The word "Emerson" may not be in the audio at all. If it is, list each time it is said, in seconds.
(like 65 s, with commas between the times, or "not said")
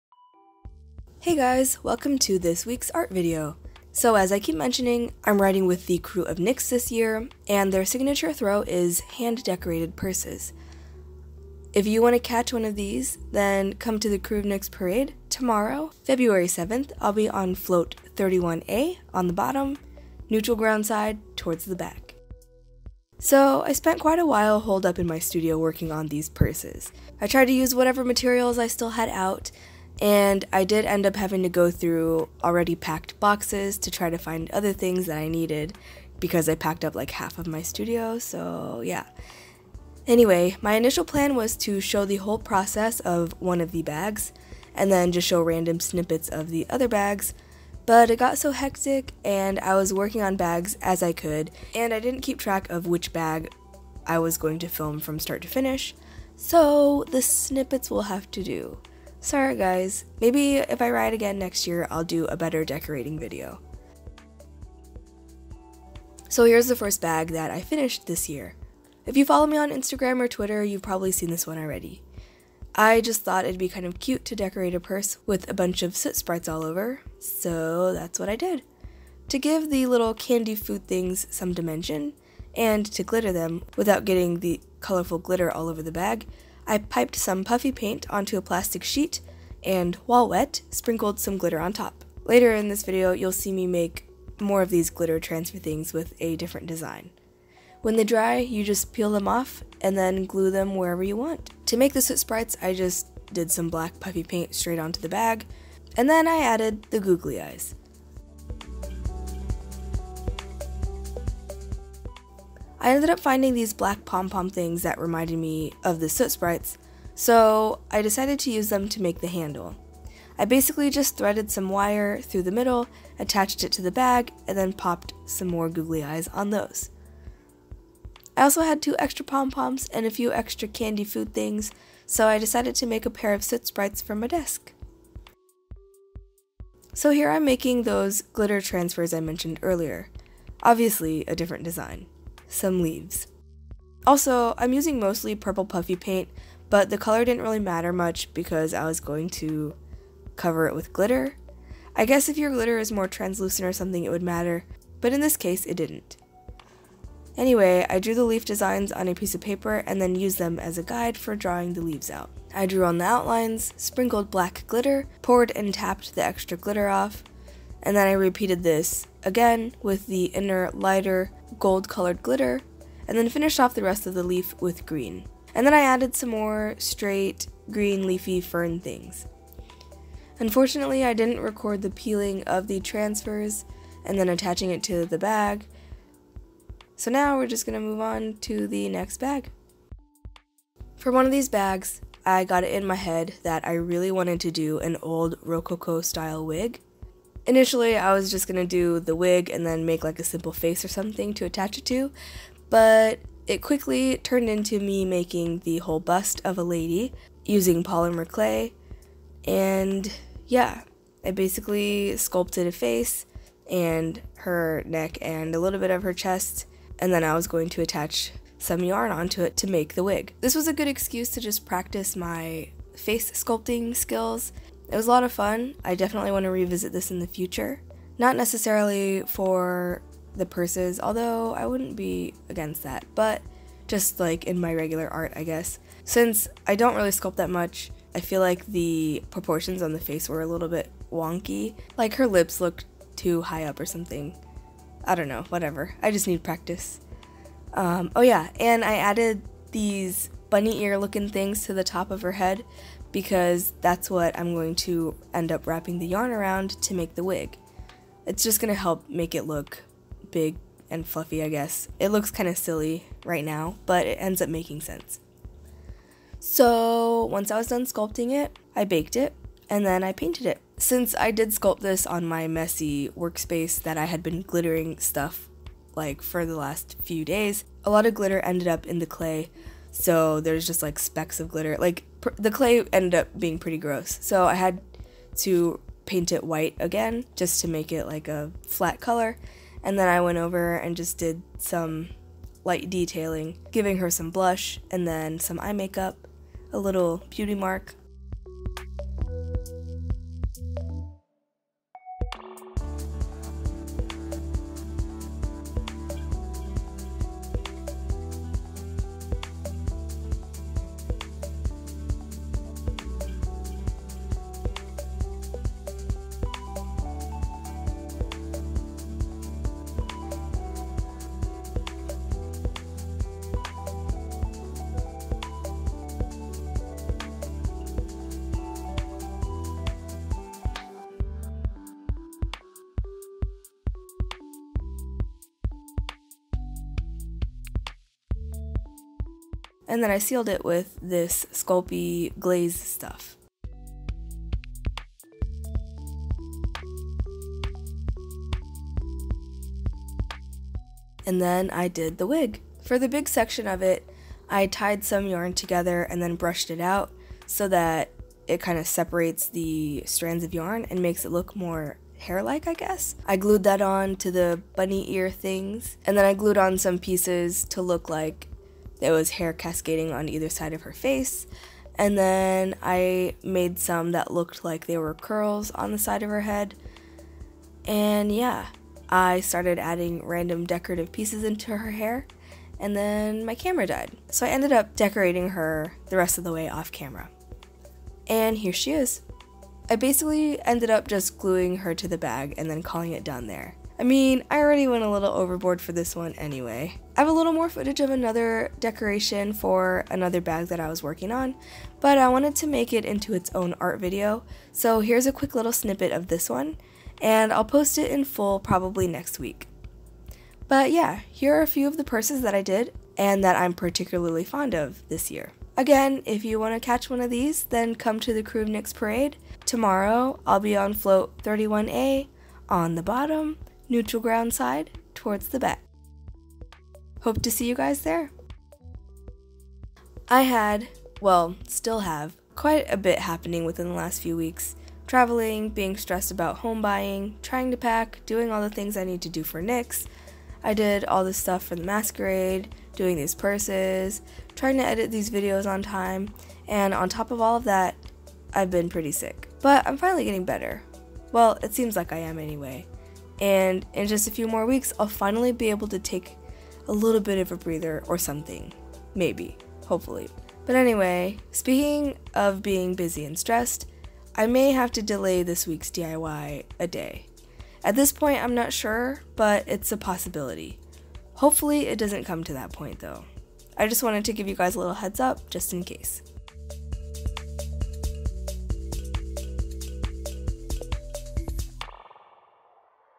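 not said.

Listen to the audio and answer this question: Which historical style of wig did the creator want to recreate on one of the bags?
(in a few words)
Rococo.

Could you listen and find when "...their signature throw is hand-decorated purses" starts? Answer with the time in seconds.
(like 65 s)
7 s.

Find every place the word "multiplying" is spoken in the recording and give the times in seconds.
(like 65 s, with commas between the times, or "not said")
not said.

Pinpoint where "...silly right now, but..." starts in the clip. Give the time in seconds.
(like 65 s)
262 s.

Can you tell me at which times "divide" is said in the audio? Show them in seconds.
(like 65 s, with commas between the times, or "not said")
not said.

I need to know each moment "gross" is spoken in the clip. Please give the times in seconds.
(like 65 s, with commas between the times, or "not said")
283 s.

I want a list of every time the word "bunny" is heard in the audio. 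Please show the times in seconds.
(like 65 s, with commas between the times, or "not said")
250 s, 364 s.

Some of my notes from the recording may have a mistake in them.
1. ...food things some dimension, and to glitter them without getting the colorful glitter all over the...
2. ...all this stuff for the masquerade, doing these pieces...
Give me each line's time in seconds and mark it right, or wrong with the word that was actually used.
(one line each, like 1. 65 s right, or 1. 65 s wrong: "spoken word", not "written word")
1. 80 s right
2. 441 s wrong: "purses", not "pieces".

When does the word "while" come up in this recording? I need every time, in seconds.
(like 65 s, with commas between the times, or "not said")
24 s, 90 s.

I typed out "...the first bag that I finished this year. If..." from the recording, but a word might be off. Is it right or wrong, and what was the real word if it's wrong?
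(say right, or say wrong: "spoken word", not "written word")
right.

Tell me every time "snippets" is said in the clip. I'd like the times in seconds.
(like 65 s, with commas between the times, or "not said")
45 s, 57 s, 405 s.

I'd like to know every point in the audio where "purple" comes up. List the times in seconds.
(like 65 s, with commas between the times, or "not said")
145 s.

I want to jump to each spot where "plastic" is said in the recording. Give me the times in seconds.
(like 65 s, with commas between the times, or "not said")
88 s.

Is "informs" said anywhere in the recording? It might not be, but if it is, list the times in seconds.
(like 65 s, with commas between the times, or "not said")
not said.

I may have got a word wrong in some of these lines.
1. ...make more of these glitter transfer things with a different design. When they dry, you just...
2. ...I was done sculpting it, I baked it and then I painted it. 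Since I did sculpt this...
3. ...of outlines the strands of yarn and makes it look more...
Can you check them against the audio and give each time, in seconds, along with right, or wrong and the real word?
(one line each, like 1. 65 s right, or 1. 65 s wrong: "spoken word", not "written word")
1. 93 s right
2. 267 s right
3. 358 s wrong: "separates", not "outlines".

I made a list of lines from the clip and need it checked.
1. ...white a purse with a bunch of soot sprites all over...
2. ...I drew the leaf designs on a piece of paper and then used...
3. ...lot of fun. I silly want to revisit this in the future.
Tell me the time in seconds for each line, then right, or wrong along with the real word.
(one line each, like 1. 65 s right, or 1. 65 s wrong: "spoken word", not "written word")
1. 74 s wrong: "decorate", not "white"
2. 157 s right
3. 225 s wrong: "definitely", not "silly".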